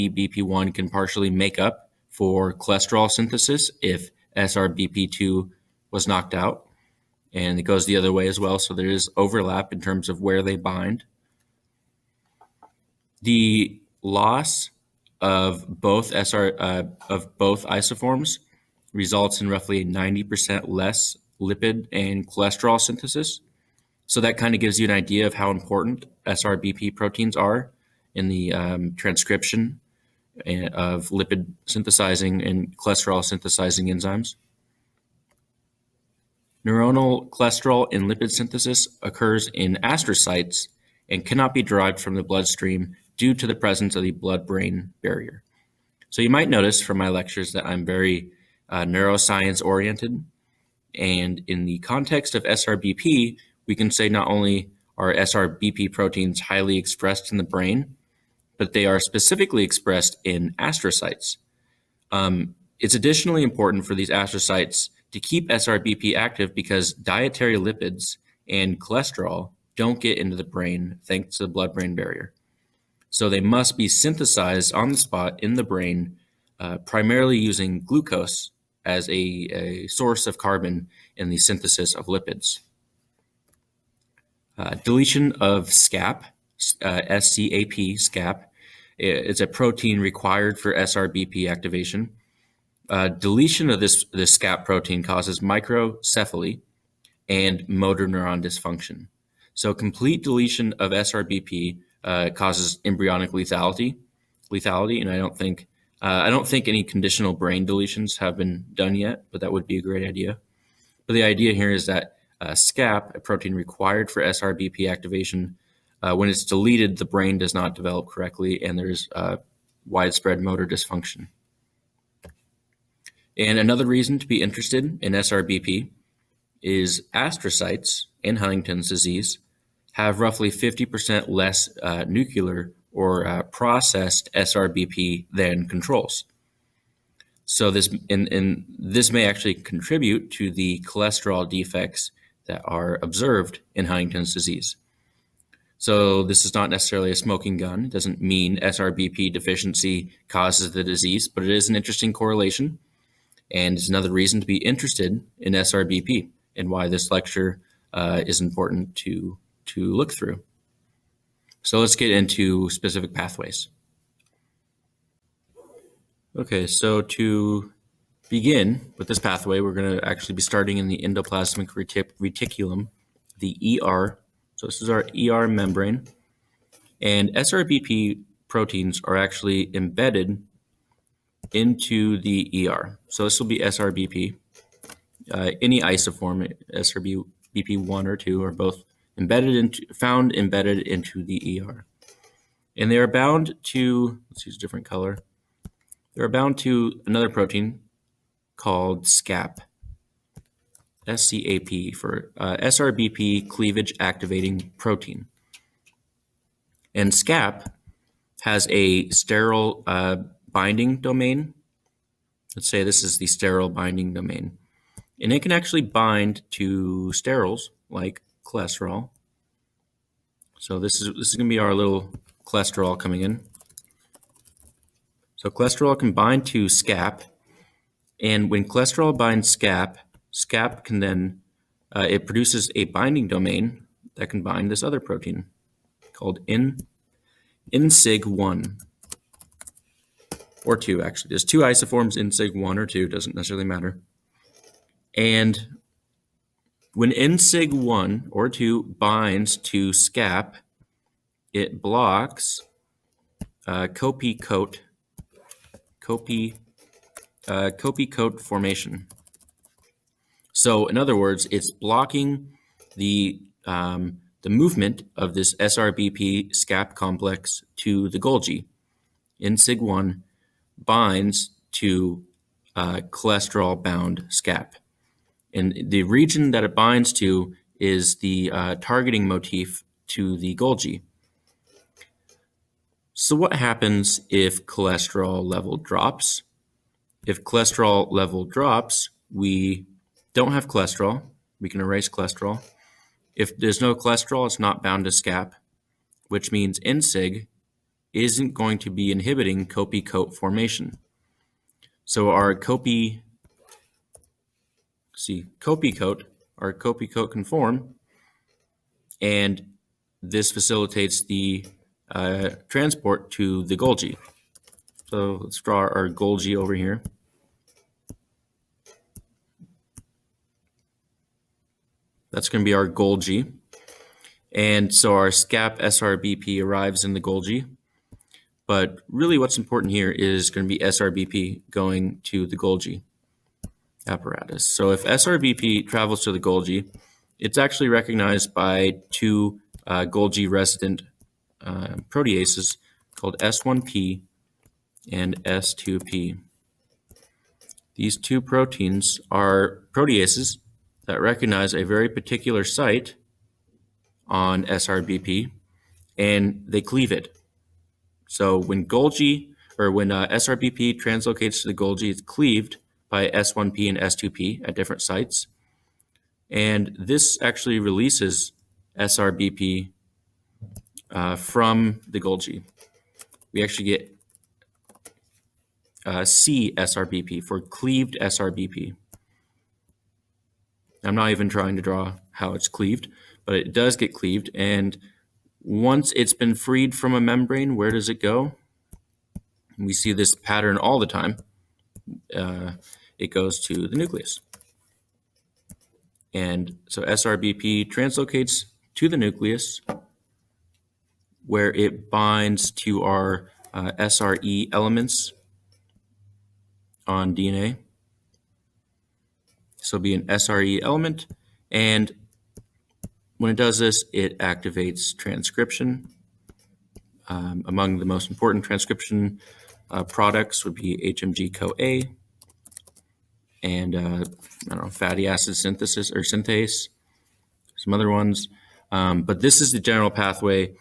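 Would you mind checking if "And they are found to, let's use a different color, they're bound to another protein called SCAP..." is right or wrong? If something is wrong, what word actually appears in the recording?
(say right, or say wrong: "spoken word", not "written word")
wrong: "bound", not "found".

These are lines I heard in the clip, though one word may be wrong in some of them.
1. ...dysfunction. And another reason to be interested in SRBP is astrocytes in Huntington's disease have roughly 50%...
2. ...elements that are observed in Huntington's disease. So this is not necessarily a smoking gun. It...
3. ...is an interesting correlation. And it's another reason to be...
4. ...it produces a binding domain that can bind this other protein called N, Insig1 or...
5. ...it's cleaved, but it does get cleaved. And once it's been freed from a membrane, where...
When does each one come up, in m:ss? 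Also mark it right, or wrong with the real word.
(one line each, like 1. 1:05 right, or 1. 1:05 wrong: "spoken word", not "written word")
1. 2:00 right
2. 2:21 wrong: "defects", not "elements"
3. 2:31 right
4. 3:52 right
5. 6:22 right.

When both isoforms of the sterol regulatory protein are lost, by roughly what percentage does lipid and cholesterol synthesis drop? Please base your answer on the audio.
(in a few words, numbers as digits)
90%.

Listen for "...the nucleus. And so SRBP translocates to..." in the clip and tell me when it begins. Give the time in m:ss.
6:33.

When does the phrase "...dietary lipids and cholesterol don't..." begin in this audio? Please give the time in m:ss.
1:06.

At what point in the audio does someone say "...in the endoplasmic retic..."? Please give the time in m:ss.
2:50.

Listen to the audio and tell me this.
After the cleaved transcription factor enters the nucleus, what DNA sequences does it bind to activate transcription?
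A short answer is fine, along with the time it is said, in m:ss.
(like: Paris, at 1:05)
SRE elements, at 6:43.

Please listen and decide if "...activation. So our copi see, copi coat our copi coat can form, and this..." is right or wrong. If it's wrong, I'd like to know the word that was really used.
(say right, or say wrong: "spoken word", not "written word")
wrong: "formation", not "activation".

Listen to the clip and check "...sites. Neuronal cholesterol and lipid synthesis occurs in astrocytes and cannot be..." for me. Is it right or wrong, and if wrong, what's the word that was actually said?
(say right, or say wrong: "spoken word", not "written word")
wrong: "enzymes", not "sites".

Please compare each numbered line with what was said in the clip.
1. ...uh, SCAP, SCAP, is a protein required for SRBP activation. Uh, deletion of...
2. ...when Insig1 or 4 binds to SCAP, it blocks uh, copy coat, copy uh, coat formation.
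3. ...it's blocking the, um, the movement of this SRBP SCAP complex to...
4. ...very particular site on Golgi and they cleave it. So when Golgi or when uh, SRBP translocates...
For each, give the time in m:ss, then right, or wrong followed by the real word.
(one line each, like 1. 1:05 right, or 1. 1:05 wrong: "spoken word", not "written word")
1. 1:26 right
2. 4:06 wrong: "2", not "4"
3. 4:21 right
4. 5:51 wrong: "SRBP", not "Golgi".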